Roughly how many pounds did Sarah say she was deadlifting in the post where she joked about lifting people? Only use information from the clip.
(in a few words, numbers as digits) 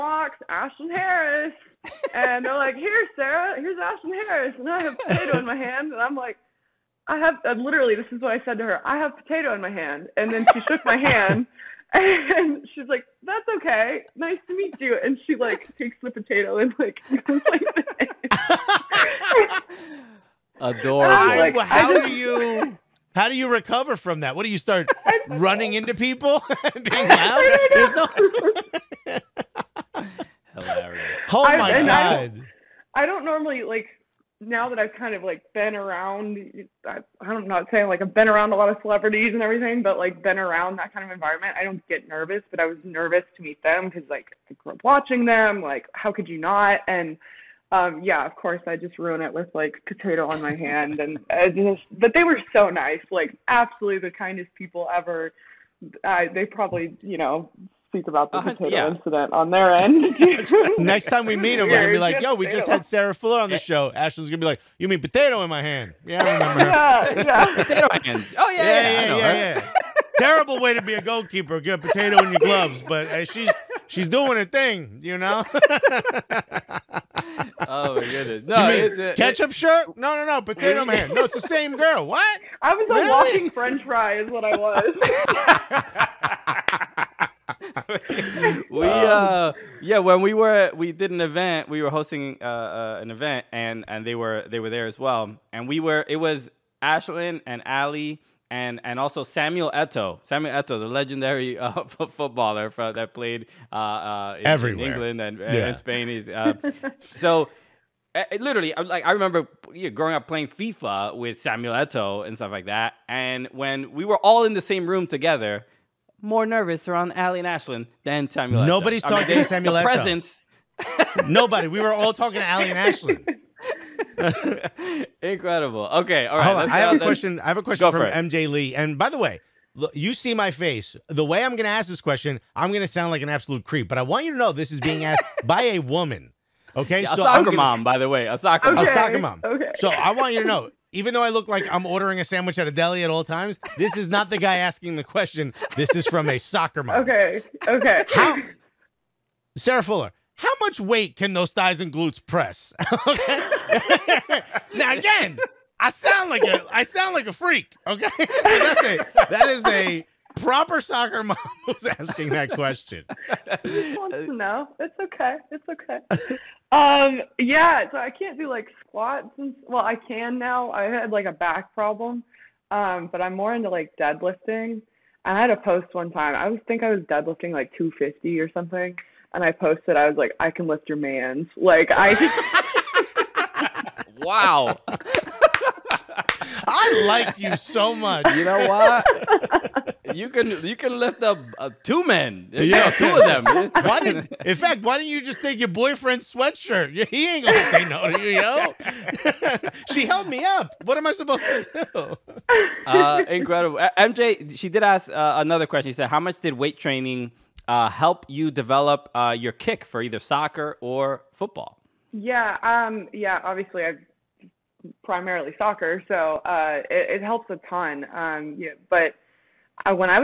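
250.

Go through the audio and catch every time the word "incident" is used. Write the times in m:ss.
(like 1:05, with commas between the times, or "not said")
0:58.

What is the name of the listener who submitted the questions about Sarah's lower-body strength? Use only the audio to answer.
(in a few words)
MJ Lee.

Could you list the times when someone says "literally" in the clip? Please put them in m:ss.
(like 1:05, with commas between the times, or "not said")
0:07, 1:48.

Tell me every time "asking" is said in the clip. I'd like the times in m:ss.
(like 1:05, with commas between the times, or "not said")
2:24, 2:41.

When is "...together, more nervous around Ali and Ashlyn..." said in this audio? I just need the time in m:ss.
1:55.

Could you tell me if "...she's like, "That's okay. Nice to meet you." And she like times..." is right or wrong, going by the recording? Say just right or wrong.
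wrong.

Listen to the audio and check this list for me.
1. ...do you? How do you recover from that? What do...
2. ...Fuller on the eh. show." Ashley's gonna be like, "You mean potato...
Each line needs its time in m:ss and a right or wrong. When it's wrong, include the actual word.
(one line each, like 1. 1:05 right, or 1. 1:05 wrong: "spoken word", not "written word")
1. 0:22 right
2. 1:03 right.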